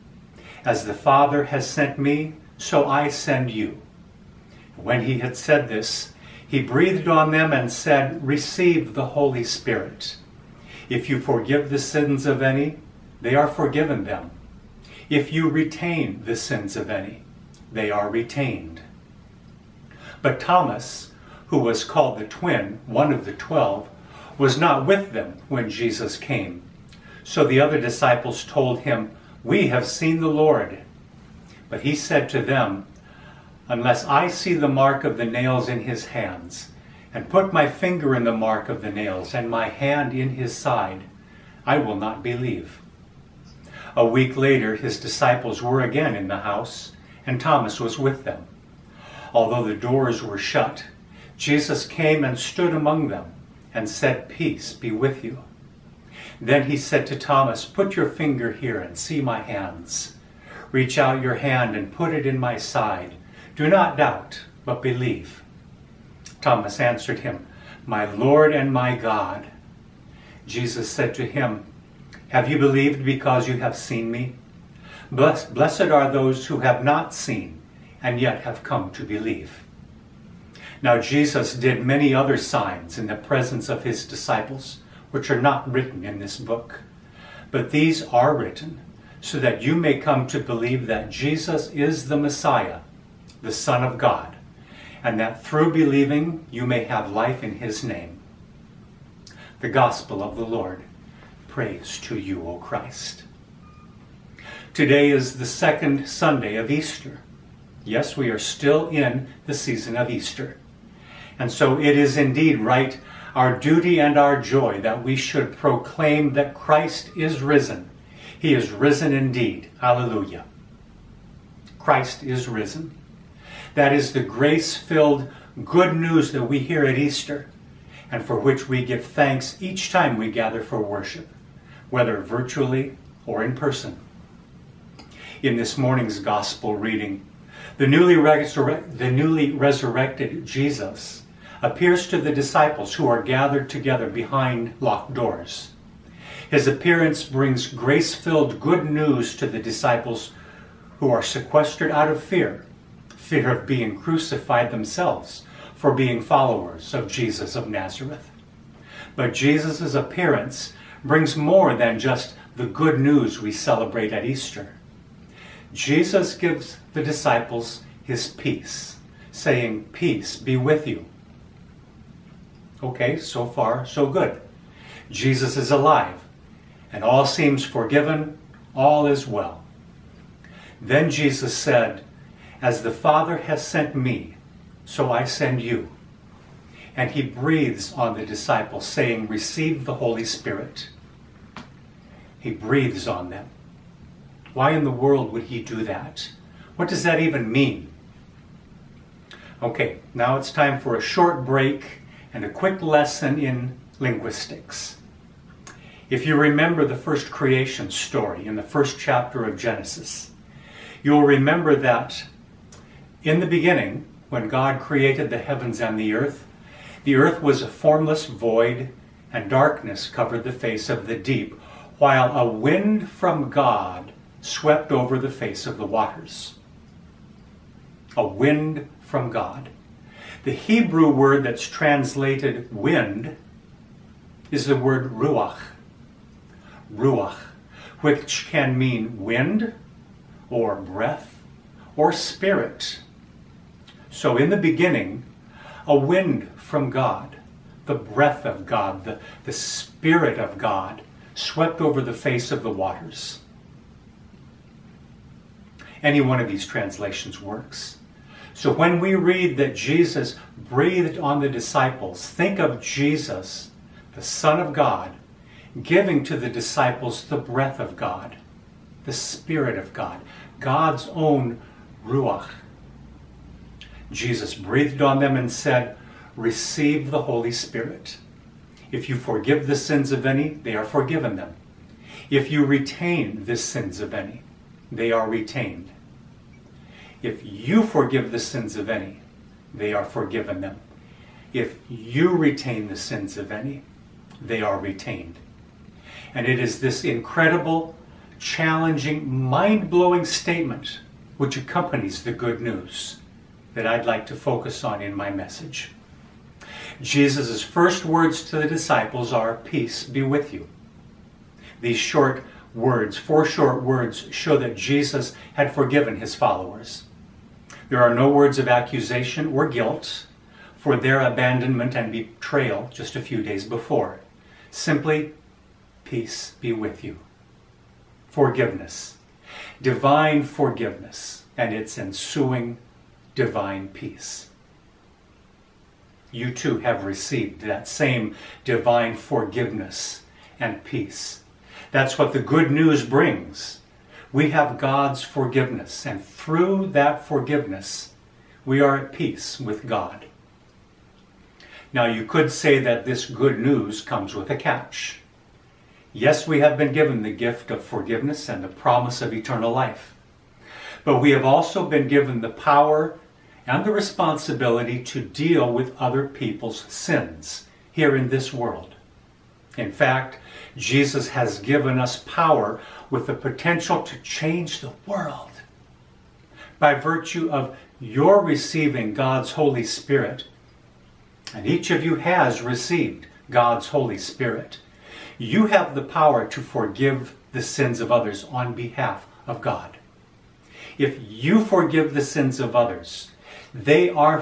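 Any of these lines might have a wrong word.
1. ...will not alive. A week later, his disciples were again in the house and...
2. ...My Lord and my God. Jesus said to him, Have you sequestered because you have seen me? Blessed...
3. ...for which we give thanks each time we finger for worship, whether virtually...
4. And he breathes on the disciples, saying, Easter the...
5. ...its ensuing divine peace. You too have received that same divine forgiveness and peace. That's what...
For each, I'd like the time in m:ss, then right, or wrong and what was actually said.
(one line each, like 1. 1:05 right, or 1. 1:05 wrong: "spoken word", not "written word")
1. 0:41 wrong: "believe", not "alive"
2. 1:07 wrong: "believed", not "sequestered"
3. 2:08 wrong: "gather", not "finger"
4. 3:06 wrong: "Receive", not "Easter"
5. 5:31 right.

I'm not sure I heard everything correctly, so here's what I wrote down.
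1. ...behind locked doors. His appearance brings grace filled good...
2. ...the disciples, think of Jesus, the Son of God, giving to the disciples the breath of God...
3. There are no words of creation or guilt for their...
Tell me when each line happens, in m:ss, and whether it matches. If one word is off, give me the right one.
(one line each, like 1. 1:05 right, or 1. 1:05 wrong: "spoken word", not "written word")
1. 2:24 right
2. 4:21 right
3. 5:17 wrong: "accusation", not "creation".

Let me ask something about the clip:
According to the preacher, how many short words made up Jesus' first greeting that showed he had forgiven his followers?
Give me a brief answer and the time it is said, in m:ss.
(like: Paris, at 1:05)
4, at 5:13.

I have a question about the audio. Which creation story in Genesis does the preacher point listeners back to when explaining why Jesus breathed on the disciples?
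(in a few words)
the first creation story.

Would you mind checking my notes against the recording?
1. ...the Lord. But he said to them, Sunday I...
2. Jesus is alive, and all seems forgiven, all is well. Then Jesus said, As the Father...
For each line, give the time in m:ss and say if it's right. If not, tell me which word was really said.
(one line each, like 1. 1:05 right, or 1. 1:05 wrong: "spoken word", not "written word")
1. 0:30 wrong: "Unless", not "Sunday"
2. 2:55 right.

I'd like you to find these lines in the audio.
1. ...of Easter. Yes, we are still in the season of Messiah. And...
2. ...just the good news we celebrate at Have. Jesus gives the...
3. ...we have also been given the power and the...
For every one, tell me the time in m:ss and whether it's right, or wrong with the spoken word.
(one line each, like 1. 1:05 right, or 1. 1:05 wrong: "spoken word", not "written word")
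1. 1:46 wrong: "Easter", not "Messiah"
2. 2:41 wrong: "Easter", not "Have"
3. 6:01 right.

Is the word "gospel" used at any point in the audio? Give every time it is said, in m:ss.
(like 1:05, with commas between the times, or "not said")
1:39, 2:16.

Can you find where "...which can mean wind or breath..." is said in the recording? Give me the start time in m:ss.
3:58.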